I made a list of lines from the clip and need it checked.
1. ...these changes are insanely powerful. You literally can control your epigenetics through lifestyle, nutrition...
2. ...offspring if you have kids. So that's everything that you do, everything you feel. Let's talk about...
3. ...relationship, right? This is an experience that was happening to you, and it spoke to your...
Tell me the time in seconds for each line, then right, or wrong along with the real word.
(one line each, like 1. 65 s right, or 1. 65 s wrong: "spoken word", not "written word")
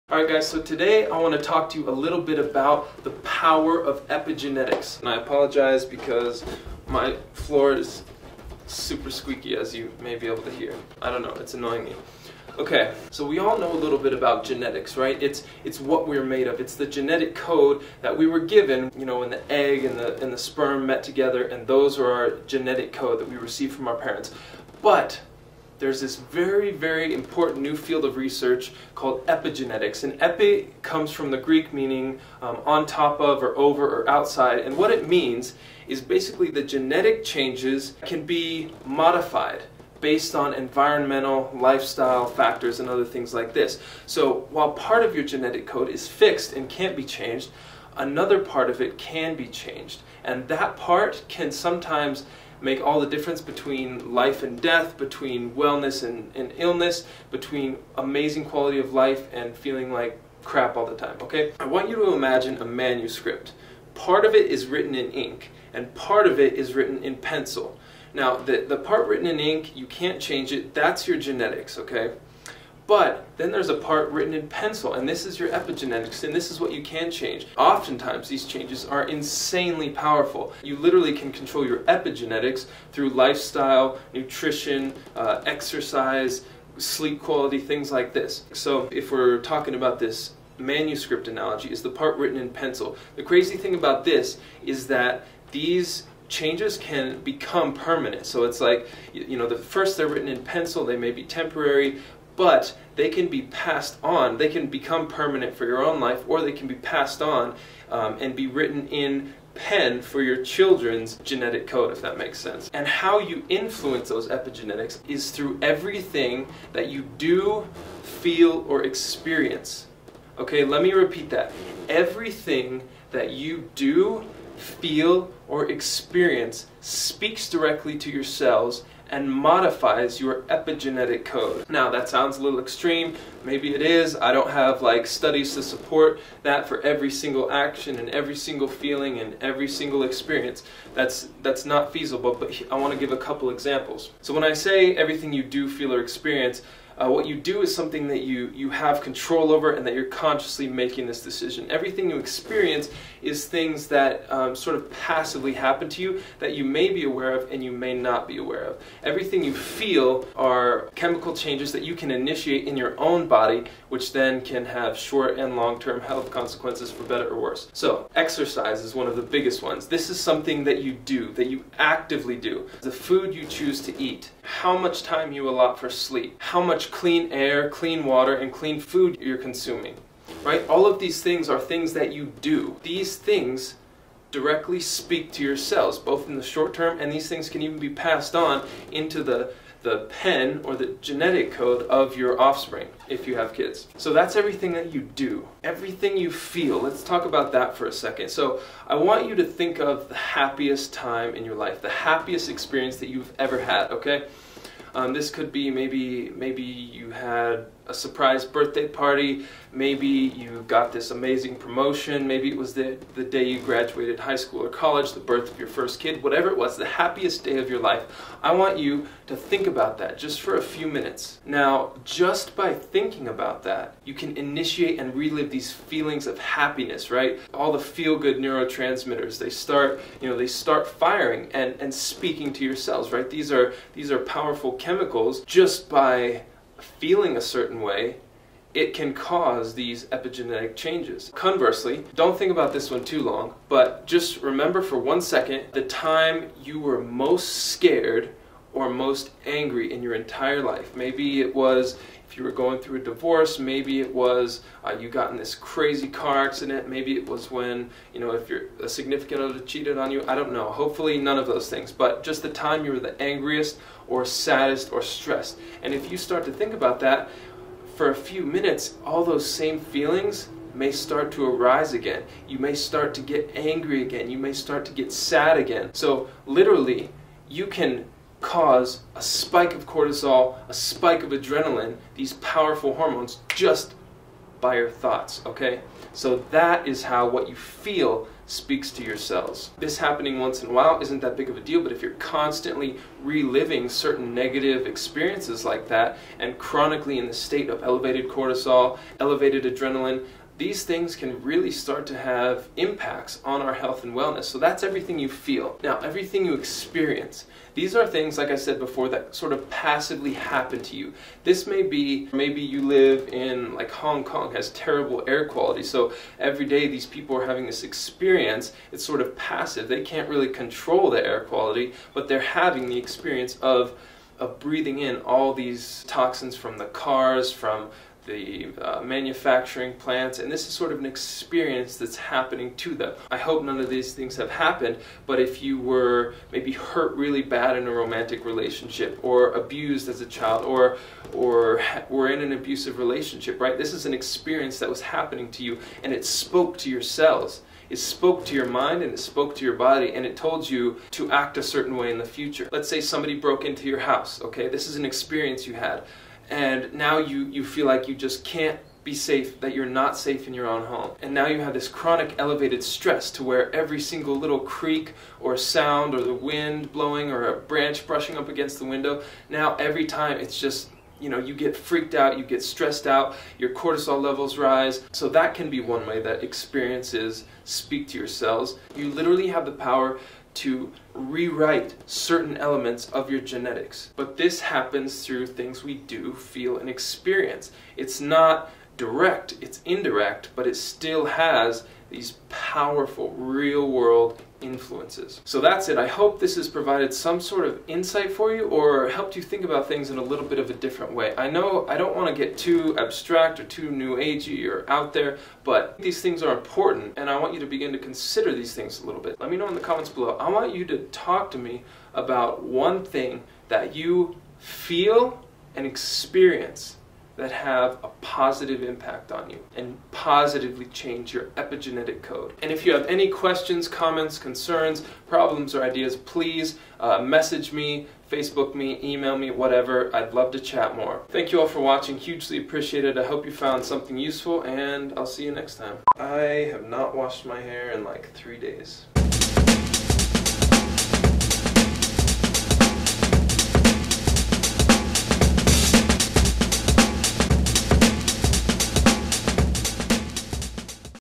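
1. 78 s right
2. 192 s right
3. 342 s right.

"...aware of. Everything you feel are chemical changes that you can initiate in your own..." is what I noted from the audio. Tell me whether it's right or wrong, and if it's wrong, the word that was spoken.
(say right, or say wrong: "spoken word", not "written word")
right.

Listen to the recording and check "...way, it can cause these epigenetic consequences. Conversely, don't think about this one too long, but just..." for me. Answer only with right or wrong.
wrong.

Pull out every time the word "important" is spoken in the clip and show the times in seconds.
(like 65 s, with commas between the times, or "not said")
27 s, 406 s.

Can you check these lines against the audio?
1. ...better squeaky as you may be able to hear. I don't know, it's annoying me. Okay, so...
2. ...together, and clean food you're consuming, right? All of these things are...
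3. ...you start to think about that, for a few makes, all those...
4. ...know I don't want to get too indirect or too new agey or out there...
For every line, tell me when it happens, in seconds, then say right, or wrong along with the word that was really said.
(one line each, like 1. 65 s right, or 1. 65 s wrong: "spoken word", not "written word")
1. 8 s wrong: "super", not "better"
2. 178 s wrong: "water", not "together"
3. 266 s wrong: "minutes", not "makes"
4. 401 s wrong: "abstract", not "indirect".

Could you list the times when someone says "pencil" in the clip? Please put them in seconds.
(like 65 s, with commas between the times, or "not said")
67 s, 74 s, 92 s, 100 s.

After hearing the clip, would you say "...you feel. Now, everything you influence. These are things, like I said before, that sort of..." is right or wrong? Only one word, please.
wrong.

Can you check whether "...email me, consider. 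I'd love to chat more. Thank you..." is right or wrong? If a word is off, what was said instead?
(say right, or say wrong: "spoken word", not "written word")
wrong: "whatever", not "consider".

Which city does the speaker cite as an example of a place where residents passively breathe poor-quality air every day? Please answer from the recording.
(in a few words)
Hong Kong.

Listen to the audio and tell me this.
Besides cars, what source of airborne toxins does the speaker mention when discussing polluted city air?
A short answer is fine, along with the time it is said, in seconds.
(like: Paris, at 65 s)
manufacturing plants, at 329 s.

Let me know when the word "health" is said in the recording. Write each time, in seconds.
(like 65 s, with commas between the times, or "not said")
166 s, 303 s.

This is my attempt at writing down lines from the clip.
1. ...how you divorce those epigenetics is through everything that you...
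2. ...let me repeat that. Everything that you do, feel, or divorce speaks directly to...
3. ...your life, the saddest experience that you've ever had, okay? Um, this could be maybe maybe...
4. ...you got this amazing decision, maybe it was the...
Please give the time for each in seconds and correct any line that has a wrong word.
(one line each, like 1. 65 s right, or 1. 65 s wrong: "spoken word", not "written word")
1. 112 s wrong: "influence", not "divorce"
2. 120 s wrong: "experience", not "divorce"
3. 201 s wrong: "happiest", not "saddest"
4. 210 s wrong: "promotion", not "decision".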